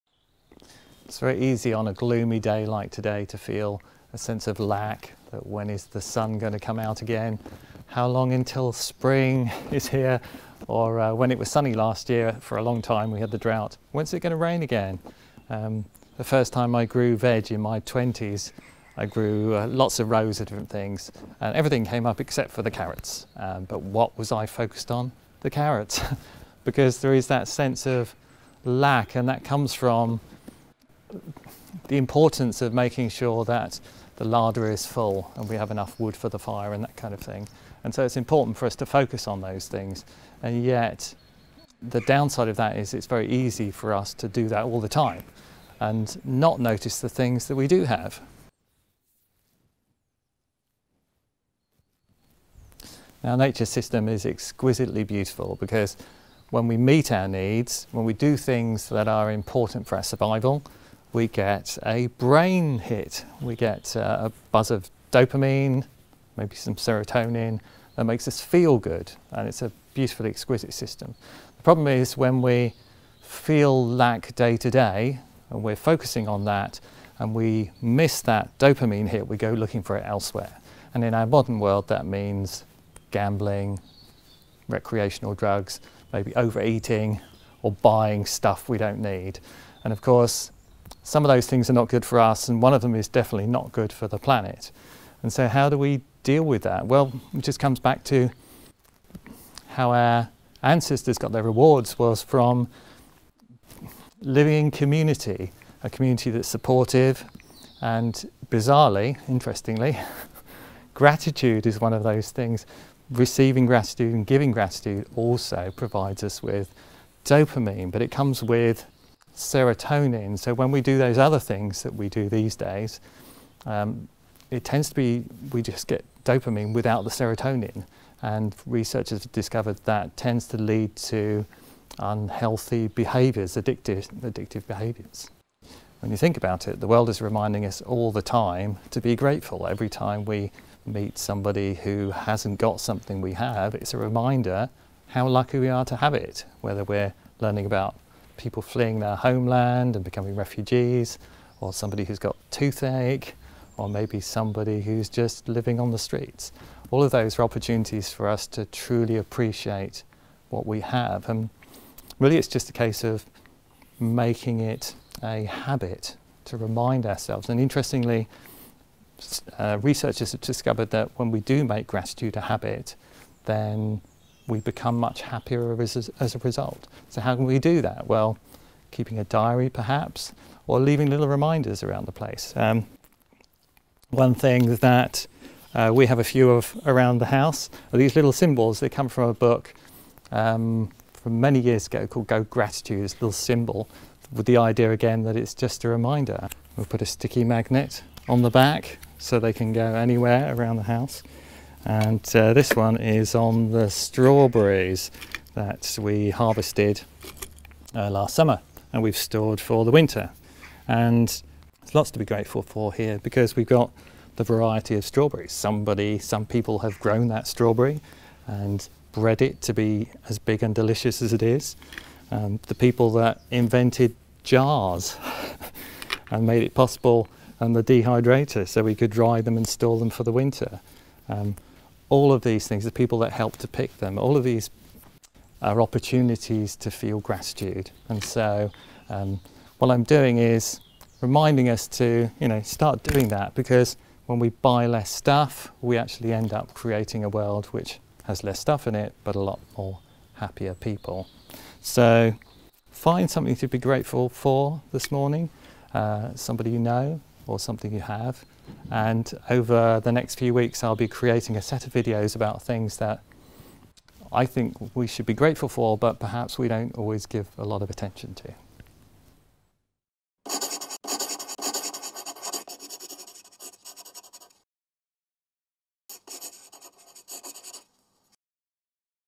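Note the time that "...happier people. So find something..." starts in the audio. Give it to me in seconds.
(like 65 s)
250 s.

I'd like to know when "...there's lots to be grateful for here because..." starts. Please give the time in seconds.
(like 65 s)
211 s.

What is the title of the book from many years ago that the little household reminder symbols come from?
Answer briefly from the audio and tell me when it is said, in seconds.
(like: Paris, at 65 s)
Go Gratitude, at 192 s.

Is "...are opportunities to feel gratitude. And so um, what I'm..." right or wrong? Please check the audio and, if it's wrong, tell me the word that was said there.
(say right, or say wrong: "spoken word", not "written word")
right.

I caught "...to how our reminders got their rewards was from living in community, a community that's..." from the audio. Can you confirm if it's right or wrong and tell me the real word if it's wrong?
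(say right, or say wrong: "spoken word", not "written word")
wrong: "ancestors", not "reminders".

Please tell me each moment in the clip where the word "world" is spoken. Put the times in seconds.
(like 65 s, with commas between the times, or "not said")
81 s, 136 s, 247 s.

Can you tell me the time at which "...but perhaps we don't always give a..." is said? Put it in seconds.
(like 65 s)
265 s.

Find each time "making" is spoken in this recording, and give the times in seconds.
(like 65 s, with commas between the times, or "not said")
32 s, 163 s.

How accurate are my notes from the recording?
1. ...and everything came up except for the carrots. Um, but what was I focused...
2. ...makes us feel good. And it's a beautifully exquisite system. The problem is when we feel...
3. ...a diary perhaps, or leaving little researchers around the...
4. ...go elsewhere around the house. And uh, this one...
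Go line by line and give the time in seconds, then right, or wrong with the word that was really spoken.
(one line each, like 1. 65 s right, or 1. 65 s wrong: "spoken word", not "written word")
1. 21 s right
2. 68 s right
3. 179 s wrong: "reminders", not "researchers"
4. 199 s wrong: "anywhere", not "elsewhere".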